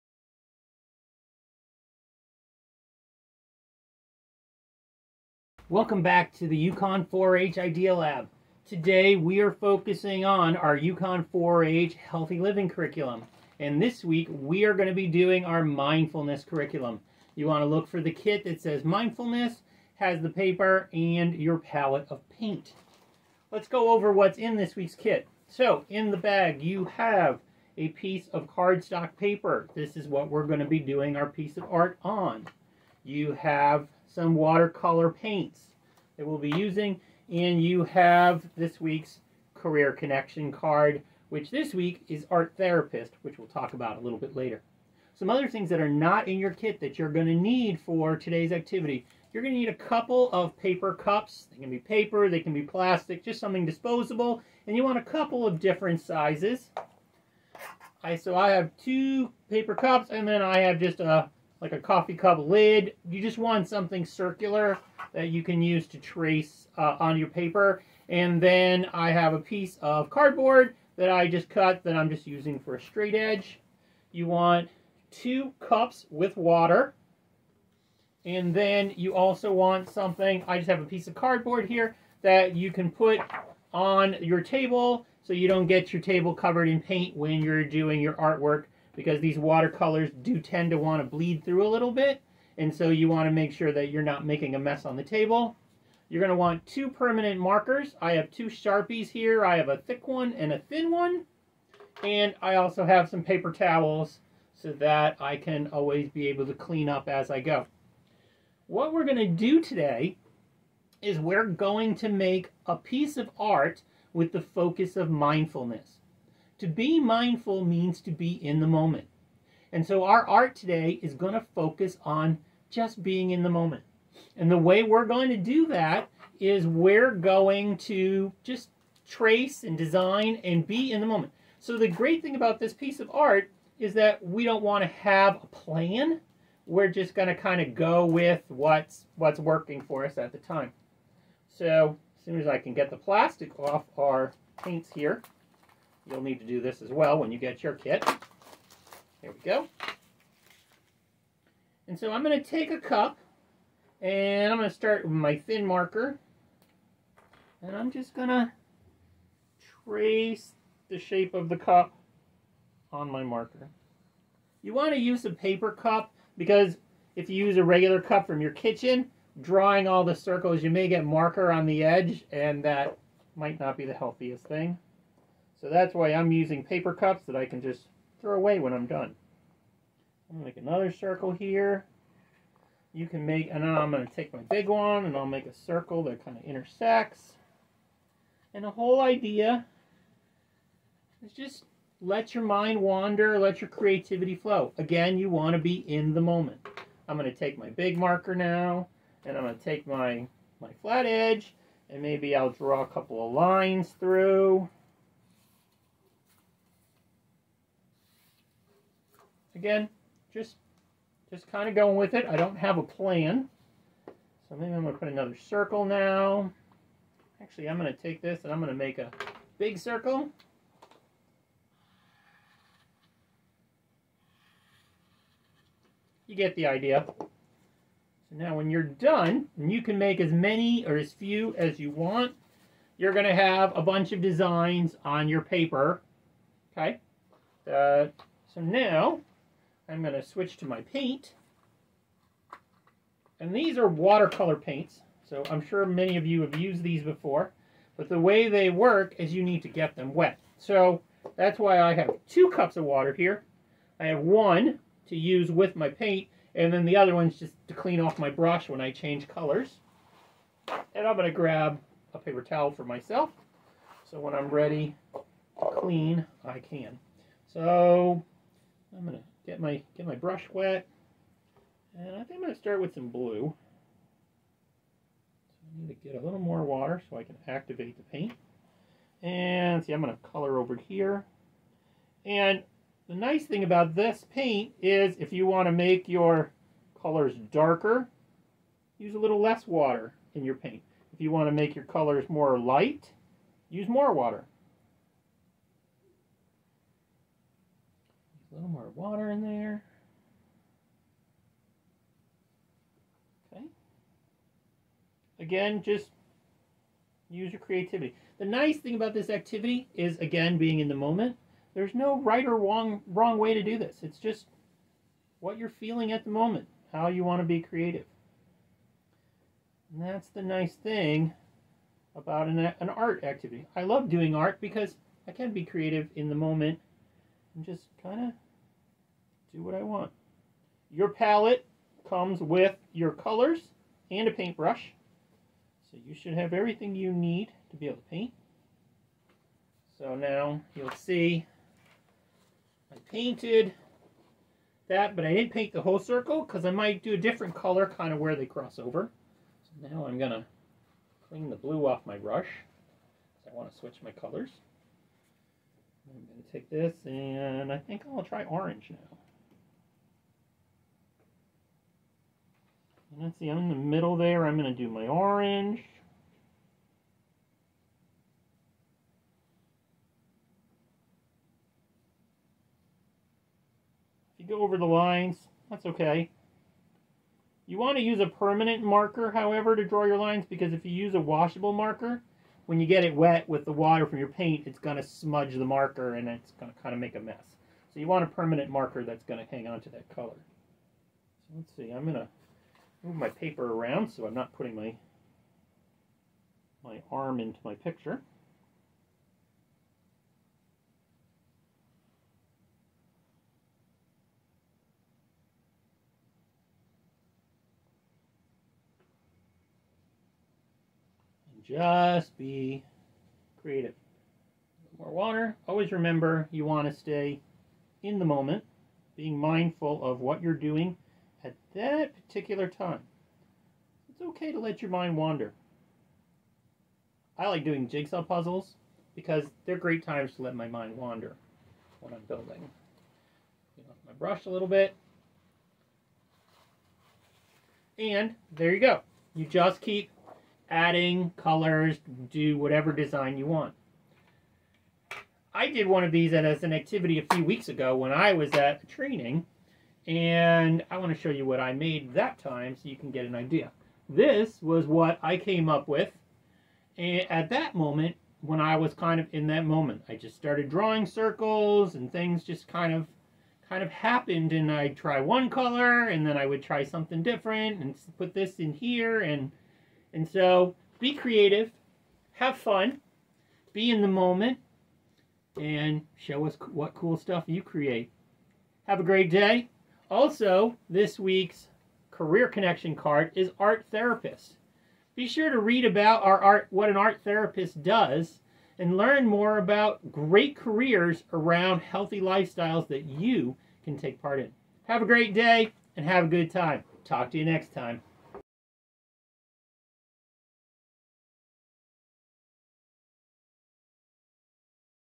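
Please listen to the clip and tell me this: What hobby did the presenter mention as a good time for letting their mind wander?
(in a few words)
jigsaw puzzles.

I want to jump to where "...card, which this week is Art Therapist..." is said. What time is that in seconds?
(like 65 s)
40 s.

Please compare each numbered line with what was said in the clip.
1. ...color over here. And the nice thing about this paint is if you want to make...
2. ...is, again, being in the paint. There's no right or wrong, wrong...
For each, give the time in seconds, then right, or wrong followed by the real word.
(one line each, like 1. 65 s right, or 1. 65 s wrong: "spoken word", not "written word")
1. 280 s right
2. 309 s wrong: "moment", not "paint".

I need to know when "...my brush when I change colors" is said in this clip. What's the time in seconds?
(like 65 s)
258 s.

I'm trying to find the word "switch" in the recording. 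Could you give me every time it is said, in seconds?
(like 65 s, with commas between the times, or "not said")
240 s, 353 s.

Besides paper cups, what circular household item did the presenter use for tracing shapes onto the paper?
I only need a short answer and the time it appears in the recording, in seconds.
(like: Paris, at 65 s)
coffee cup lid, at 61 s.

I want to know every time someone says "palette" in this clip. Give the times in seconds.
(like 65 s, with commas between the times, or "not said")
21 s, 331 s.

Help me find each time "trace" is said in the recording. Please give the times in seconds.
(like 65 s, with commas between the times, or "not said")
65 s, 129 s, 159 s.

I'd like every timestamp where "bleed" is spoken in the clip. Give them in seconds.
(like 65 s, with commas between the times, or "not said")
91 s.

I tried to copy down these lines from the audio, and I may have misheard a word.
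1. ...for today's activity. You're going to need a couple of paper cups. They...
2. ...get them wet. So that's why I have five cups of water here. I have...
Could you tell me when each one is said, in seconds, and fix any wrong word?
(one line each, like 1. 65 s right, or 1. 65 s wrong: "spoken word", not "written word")
1. 47 s right
2. 249 s wrong: "two", not "five".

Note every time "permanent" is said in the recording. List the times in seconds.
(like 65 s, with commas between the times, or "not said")
96 s, 378 s, 388 s.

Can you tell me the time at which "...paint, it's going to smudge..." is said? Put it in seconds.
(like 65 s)
384 s.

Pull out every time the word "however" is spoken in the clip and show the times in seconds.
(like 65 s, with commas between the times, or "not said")
379 s.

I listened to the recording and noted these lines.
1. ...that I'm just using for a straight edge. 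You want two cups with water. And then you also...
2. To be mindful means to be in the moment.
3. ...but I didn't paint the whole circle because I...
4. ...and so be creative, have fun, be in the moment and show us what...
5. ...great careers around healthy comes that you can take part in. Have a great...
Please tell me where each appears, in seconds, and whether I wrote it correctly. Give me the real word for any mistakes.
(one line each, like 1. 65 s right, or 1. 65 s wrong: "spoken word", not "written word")
1. 71 s right
2. 116 s right
3. 345 s right
4. 470 s right
5. 490 s wrong: "lifestyles", not "comes".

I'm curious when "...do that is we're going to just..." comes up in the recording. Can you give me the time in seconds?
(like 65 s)
125 s.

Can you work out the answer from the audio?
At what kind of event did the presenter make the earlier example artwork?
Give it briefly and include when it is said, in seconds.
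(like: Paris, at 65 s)
a training, at 448 s.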